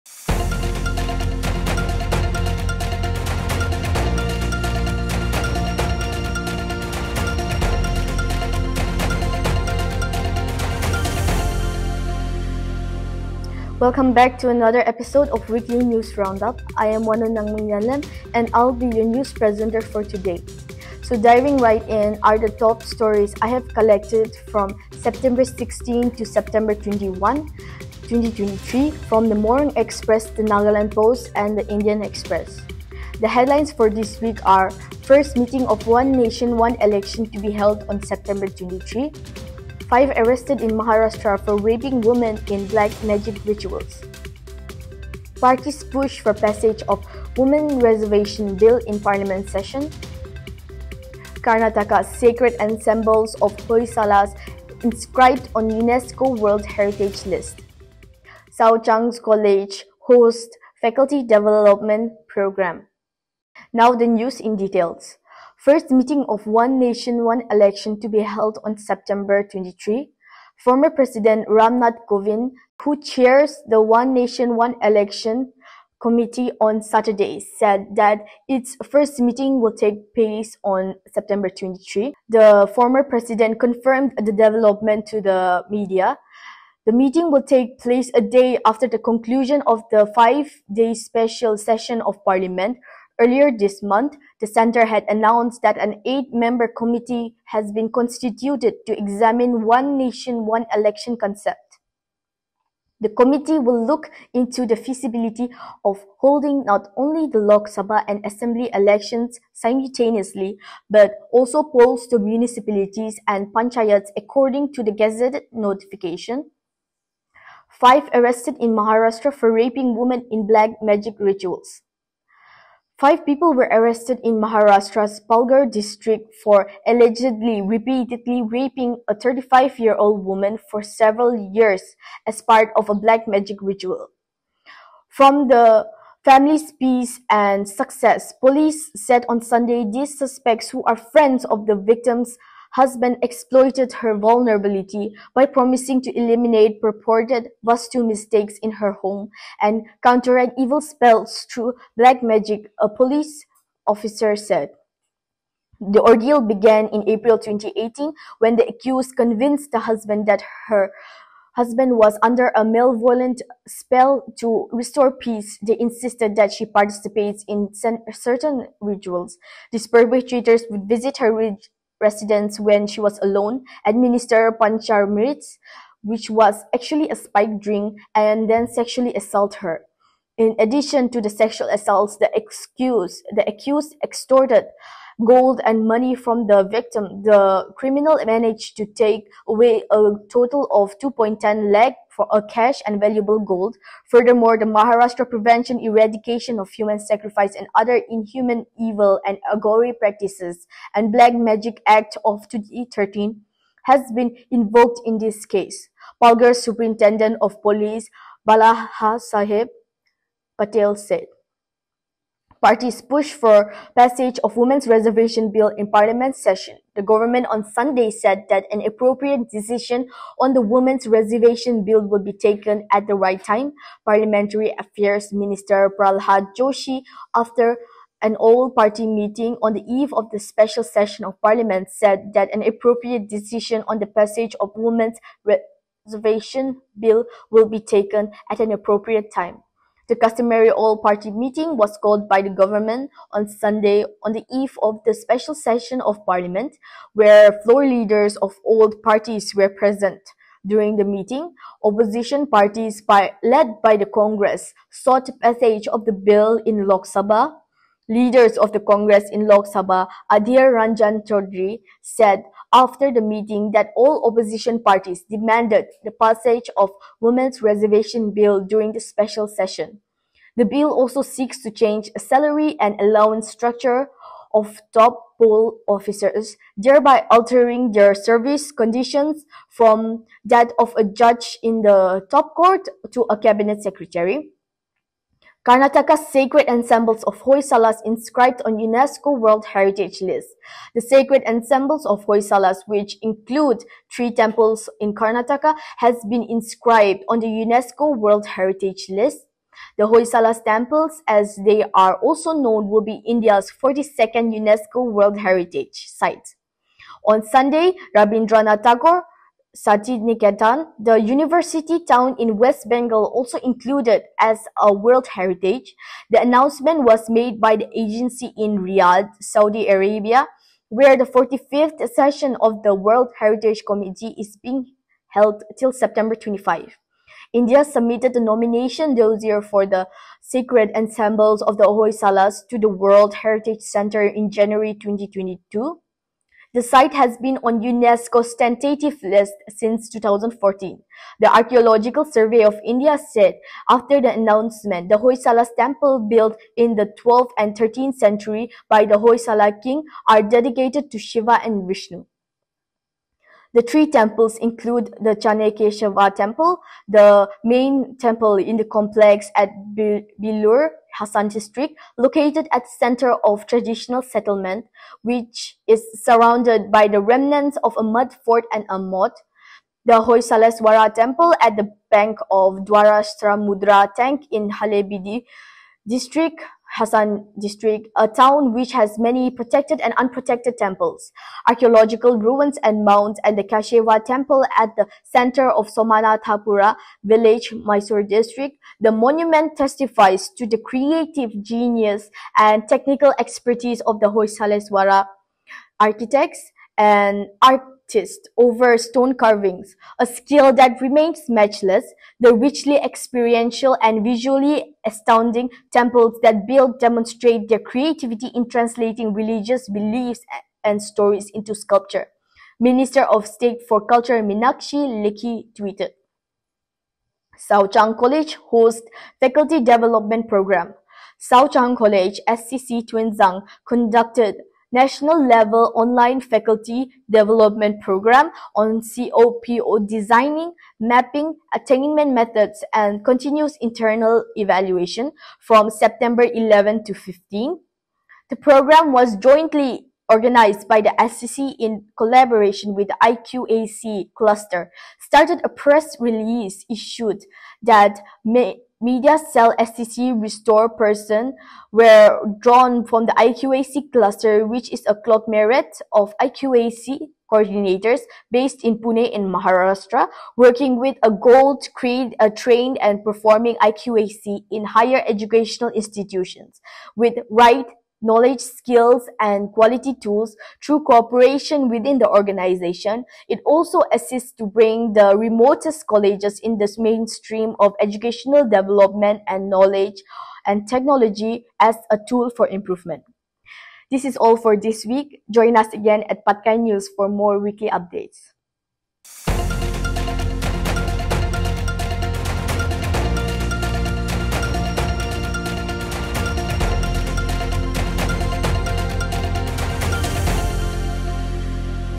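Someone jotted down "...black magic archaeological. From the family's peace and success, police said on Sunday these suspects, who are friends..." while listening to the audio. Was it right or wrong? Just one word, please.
wrong.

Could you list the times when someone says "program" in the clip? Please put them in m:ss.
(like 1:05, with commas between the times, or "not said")
1:02, 7:00, 7:08, 7:18.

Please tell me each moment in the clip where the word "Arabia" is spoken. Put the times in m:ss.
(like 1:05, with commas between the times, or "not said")
5:19.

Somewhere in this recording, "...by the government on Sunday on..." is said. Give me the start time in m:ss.
4:02.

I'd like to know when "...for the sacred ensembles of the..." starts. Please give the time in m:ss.
5:29.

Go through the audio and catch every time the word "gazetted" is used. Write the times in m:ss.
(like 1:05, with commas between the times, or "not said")
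1:54.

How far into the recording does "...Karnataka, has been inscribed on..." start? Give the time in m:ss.
4:55.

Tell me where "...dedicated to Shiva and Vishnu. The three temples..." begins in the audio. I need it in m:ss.
5:50.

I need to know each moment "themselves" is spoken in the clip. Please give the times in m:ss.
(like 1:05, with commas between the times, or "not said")
not said.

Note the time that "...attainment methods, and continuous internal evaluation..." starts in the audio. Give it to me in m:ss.
7:11.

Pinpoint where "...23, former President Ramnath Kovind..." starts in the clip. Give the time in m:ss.
1:09.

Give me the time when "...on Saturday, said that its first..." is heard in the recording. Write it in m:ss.
1:16.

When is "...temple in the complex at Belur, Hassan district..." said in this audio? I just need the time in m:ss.
5:58.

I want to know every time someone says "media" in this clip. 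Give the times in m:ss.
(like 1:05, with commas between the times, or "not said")
1:25, 7:29.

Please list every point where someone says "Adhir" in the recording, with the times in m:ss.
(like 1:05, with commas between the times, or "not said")
4:20.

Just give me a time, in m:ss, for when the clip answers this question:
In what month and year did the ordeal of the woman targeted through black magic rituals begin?
2:37.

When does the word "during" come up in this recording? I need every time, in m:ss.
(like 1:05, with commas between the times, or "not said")
4:10, 4:28.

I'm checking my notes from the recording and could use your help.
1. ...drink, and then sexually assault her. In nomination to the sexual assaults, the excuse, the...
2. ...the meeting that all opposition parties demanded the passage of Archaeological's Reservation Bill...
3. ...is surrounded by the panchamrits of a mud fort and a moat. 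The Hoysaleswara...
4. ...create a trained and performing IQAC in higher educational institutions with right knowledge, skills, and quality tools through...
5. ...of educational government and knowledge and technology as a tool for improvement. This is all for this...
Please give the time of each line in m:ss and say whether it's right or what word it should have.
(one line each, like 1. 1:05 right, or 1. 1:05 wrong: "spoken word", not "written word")
1. 2:57 wrong: "addition", not "nomination"
2. 4:23 wrong: "Women", not "Archaeological"
3. 6:05 wrong: "remnants", not "panchamrits"
4. 7:41 right
5. 7:57 wrong: "development", not "government".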